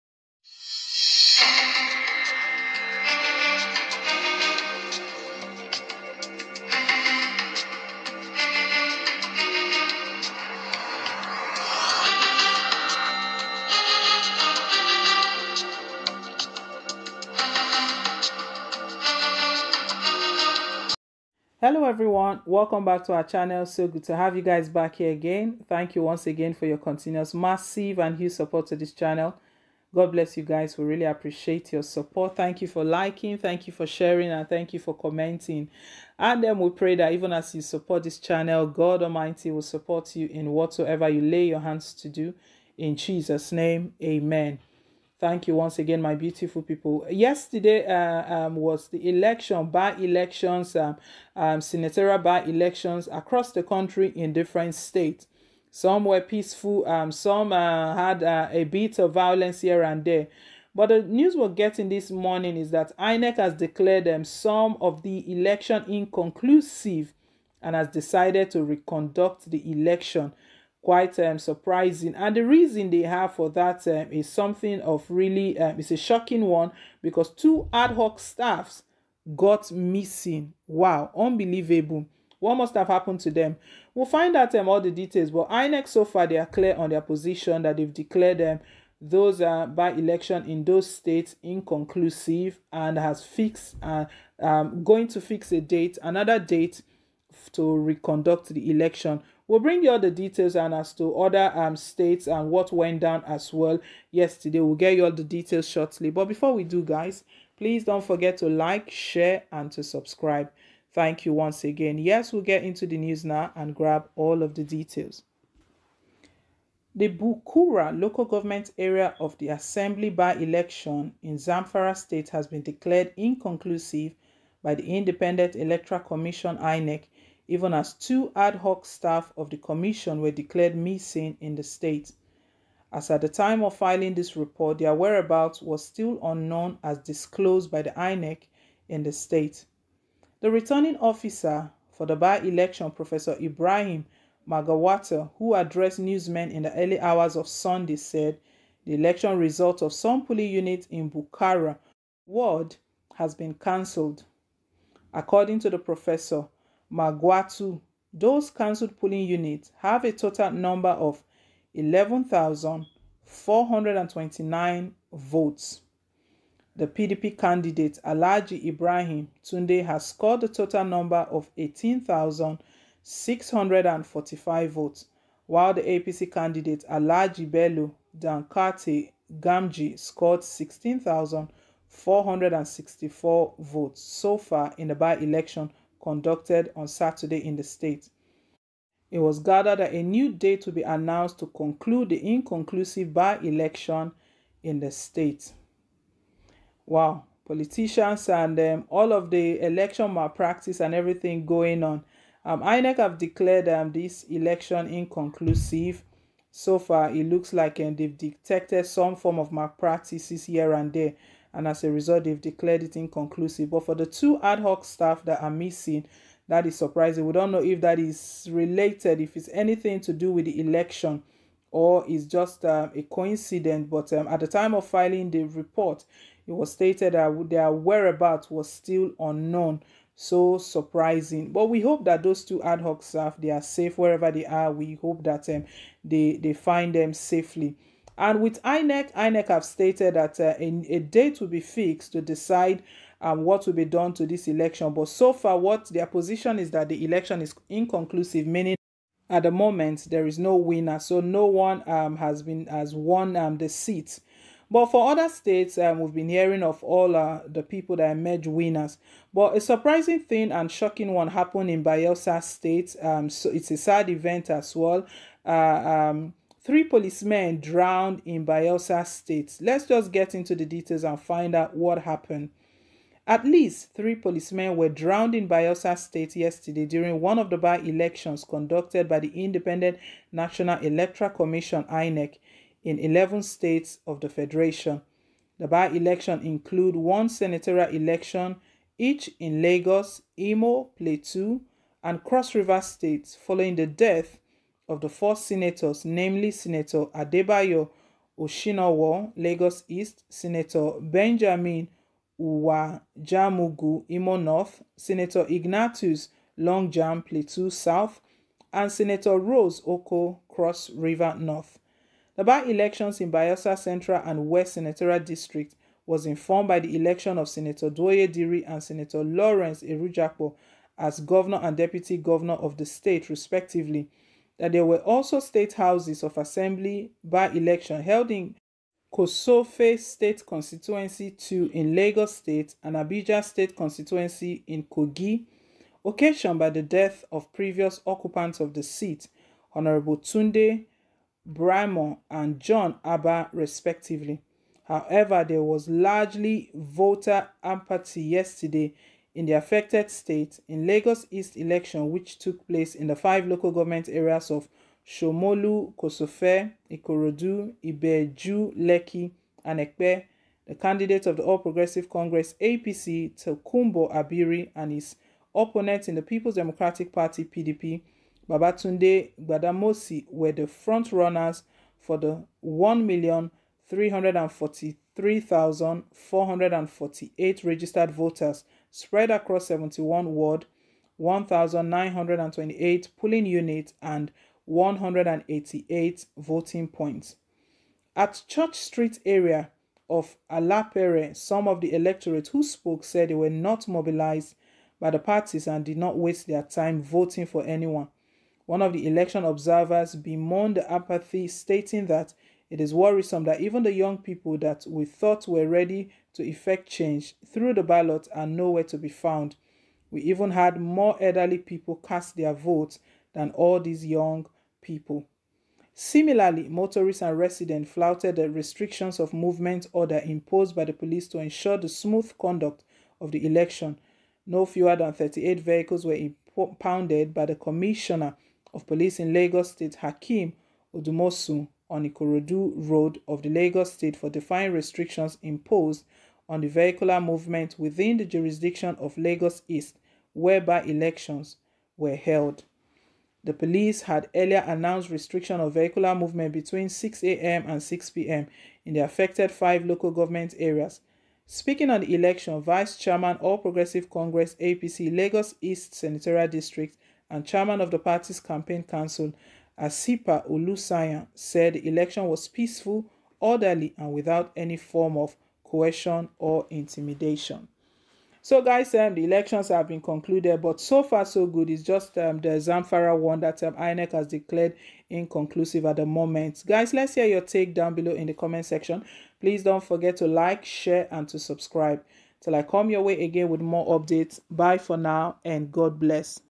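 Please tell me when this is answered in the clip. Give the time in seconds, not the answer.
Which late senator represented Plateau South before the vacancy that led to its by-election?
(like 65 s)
305 s.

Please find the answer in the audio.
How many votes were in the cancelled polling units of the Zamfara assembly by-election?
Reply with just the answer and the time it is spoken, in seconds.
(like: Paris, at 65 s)
11,429, at 161 s.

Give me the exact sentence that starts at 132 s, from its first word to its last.
As at the time of filing this report, their whereabouts was still unknown as disclosed by the INEC in the state.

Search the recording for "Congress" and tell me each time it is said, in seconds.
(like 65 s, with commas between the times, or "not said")
362 s, 454 s.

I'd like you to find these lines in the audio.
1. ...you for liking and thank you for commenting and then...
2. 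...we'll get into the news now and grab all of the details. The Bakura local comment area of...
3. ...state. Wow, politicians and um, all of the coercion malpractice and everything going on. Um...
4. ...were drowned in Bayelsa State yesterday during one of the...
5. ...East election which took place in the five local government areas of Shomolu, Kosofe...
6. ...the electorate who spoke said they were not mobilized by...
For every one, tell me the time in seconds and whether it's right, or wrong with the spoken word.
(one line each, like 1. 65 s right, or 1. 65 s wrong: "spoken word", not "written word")
1. 33 s wrong: "sharing", not "liking"
2. 112 s wrong: "government", not "comment"
3. 194 s wrong: "election", not "coercion"
4. 274 s right
5. 351 s right
6. 391 s right.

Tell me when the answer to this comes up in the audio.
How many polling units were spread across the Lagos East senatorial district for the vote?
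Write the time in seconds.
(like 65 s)
381 s.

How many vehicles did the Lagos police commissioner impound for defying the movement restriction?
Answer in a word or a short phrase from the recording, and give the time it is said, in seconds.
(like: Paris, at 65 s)
38, at 425 s.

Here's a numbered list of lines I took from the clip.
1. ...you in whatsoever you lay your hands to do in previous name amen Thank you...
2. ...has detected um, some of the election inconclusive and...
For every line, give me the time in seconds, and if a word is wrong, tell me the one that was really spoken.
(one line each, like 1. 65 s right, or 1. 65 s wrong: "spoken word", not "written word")
1. 40 s wrong: "jesus", not "previous"
2. 63 s wrong: "declared", not "detected".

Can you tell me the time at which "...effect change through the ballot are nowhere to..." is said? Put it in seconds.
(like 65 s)
406 s.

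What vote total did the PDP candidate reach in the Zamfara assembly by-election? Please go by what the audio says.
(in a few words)
18,645.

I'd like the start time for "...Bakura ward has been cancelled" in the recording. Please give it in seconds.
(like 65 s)
151 s.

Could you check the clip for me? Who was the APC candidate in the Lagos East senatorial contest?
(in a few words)
Tokumbo Abiri.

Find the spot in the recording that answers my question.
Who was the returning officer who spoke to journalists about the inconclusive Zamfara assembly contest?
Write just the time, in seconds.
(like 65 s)
142 s.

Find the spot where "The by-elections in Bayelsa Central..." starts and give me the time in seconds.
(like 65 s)
312 s.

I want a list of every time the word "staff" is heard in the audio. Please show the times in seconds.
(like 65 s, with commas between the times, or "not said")
78 s, 128 s, 214 s, 233 s.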